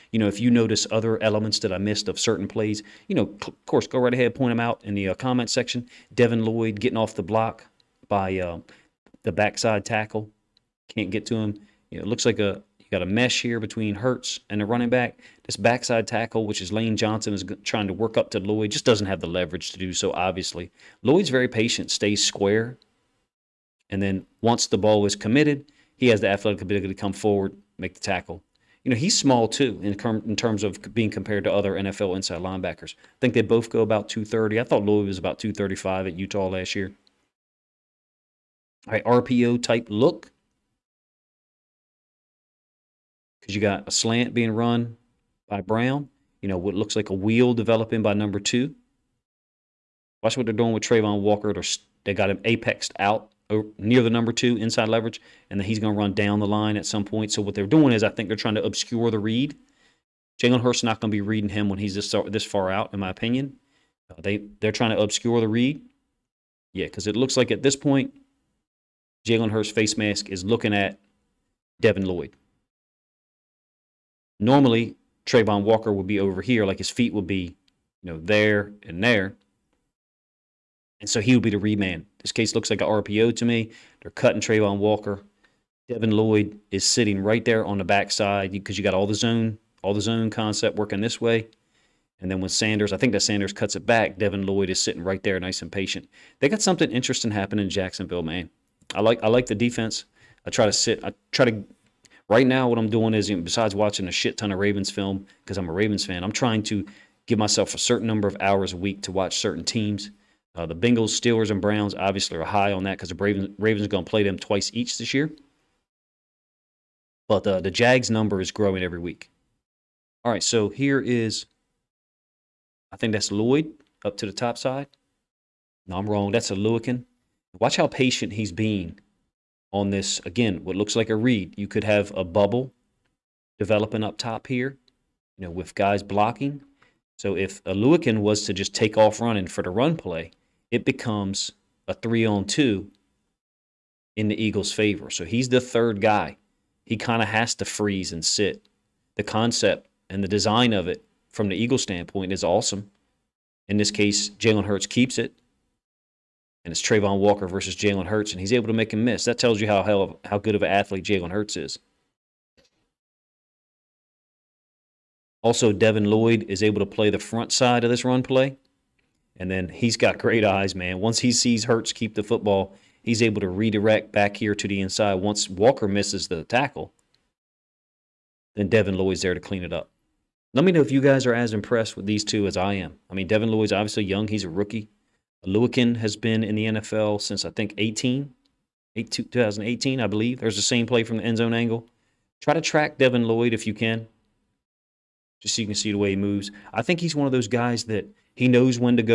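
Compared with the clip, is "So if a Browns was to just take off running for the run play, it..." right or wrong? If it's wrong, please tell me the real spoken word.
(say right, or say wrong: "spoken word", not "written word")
wrong: "Oluokun", not "Browns".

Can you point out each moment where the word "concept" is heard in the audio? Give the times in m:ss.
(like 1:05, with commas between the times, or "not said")
1:30, 2:29.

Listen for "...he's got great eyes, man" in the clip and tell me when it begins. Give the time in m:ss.
2:49.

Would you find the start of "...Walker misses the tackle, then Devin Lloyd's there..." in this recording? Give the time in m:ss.
2:55.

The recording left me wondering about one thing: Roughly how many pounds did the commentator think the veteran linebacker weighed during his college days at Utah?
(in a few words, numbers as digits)
235.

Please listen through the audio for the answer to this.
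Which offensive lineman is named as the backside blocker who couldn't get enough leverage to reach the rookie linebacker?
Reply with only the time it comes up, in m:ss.
0:16.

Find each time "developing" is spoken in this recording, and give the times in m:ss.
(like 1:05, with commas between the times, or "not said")
0:47, 2:13.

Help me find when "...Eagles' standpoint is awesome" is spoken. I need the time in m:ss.
2:31.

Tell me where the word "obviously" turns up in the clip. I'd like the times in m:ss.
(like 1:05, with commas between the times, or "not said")
0:20, 1:51, 3:03.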